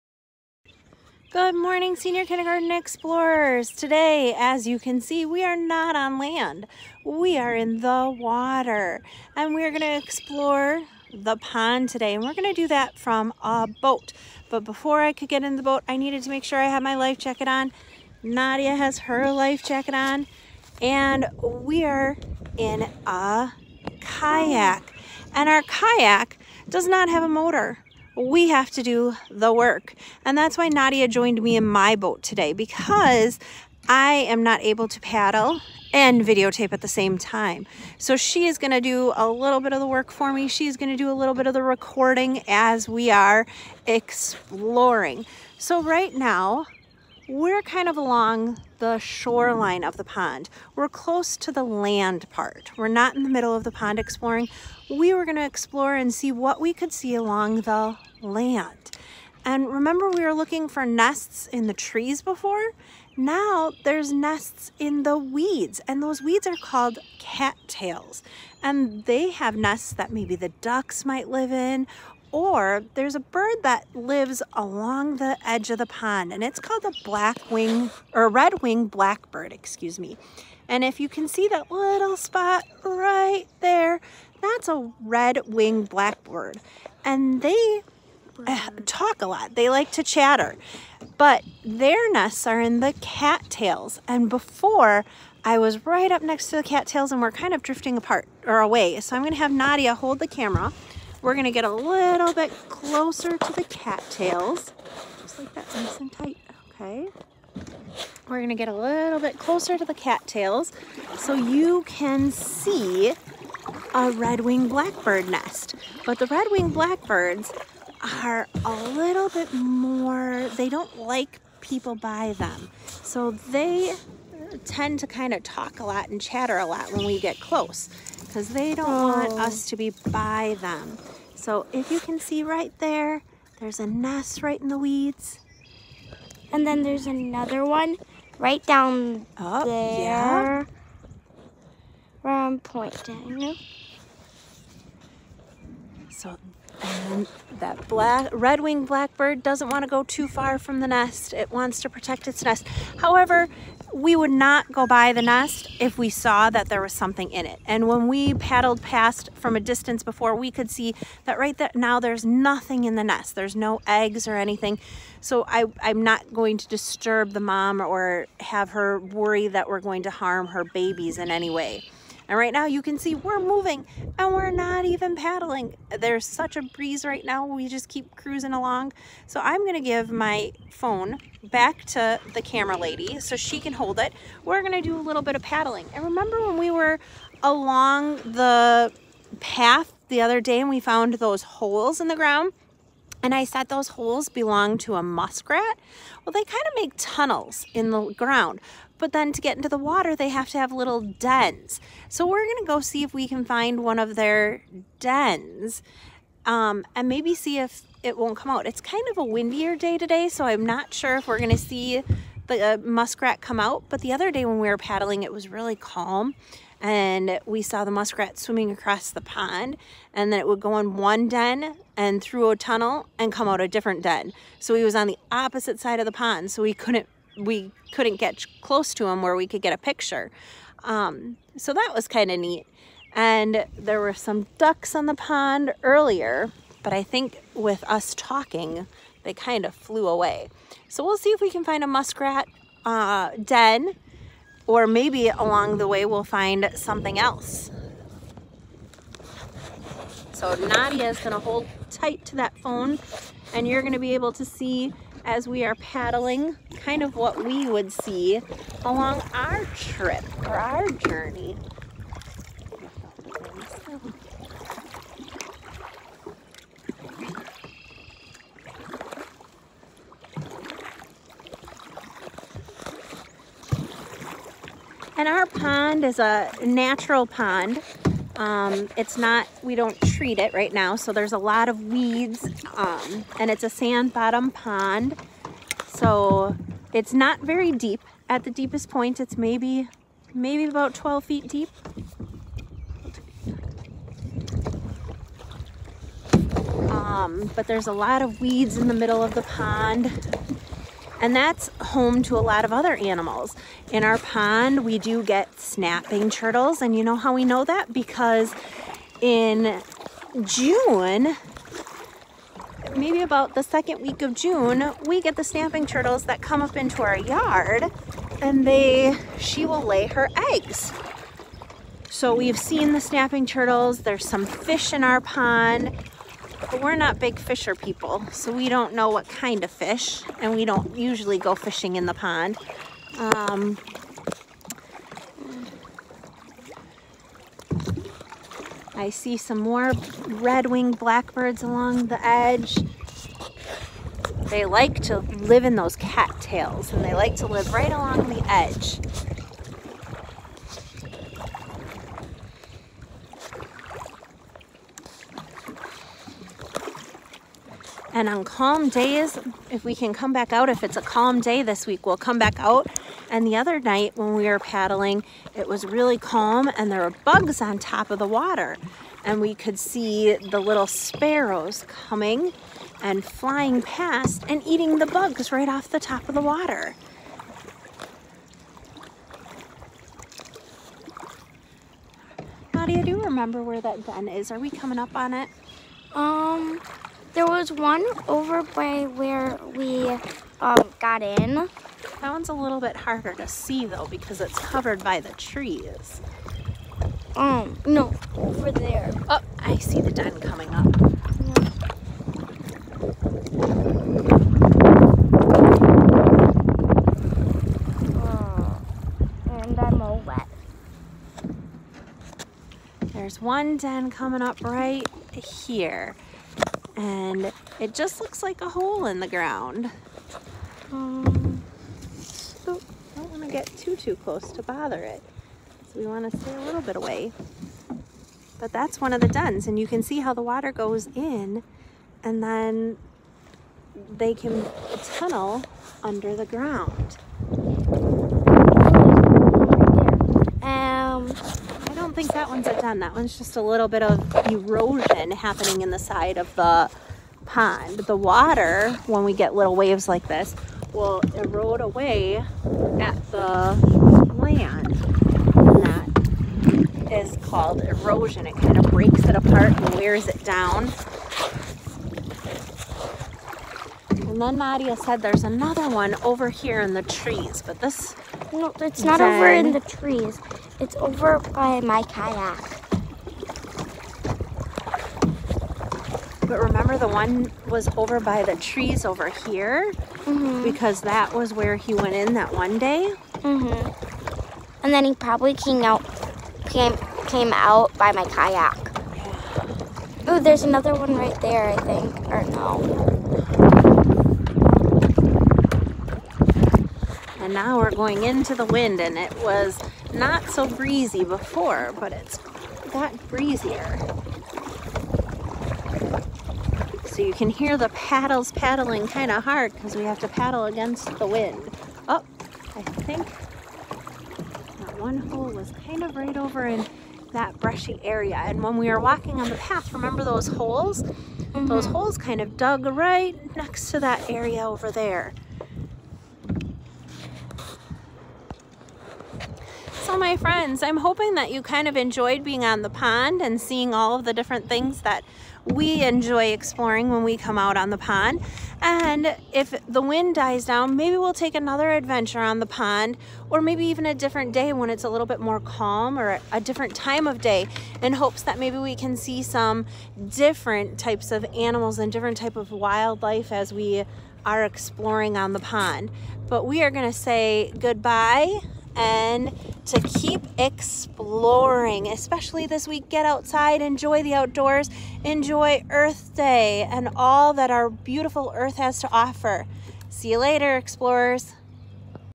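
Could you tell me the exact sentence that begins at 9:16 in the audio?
But we are gonna say goodbye and to keep exploring, especially this week.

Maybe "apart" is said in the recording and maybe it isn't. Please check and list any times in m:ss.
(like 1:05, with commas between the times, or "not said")
1:37, 7:39.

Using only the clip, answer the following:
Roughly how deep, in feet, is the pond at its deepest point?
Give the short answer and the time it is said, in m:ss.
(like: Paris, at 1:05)
12 feet, at 4:50.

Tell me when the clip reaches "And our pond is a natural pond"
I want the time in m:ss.
4:35.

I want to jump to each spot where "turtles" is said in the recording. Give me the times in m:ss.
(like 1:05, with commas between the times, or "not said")
5:06, 5:15, 5:23.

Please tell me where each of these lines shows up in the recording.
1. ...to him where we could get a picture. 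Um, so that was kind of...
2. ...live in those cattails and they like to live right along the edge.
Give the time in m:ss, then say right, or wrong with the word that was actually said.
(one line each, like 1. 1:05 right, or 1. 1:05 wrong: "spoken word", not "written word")
1. 3:48 right
2. 5:45 right.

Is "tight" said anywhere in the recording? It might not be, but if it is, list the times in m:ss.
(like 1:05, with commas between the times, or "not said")
1:46, 4:11.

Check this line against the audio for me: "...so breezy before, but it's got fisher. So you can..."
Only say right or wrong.
wrong.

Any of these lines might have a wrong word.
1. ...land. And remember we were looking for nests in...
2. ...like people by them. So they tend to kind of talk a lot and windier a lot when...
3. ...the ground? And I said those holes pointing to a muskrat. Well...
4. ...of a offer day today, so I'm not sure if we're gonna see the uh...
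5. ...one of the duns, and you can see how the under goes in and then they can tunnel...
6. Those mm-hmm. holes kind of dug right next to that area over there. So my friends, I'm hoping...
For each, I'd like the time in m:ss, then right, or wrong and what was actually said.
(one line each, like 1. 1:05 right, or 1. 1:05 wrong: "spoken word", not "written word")
1. 0:58 right
2. 2:00 wrong: "chatter", not "windier"
3. 3:12 wrong: "belong", not "pointing"
4. 3:29 wrong: "windier", not "offer"
5. 7:09 wrong: "water", not "under"
6. 8:41 right.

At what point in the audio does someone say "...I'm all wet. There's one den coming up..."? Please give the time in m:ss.
6:49.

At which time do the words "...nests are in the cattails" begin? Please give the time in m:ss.
1:32.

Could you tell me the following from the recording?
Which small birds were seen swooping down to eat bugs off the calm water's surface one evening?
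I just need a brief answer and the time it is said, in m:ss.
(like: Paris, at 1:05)
Sparrows, at 6:10.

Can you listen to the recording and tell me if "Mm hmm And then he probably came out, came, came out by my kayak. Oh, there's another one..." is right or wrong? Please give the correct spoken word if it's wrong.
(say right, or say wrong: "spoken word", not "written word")
right.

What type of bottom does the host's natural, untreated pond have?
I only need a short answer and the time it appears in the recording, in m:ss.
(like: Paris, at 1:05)
Sand, at 4:43.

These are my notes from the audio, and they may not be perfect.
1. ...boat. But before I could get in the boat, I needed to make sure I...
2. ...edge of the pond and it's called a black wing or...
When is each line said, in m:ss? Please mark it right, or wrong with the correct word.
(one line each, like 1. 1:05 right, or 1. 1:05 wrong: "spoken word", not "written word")
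1. 0:13 right
2. 1:15 right.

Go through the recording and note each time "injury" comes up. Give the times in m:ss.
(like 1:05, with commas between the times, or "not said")
not said.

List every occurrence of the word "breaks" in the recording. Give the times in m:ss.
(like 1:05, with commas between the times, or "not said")
7:38.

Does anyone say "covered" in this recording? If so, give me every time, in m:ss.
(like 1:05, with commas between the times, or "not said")
6:34.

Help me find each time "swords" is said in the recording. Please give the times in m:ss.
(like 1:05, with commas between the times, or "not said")
not said.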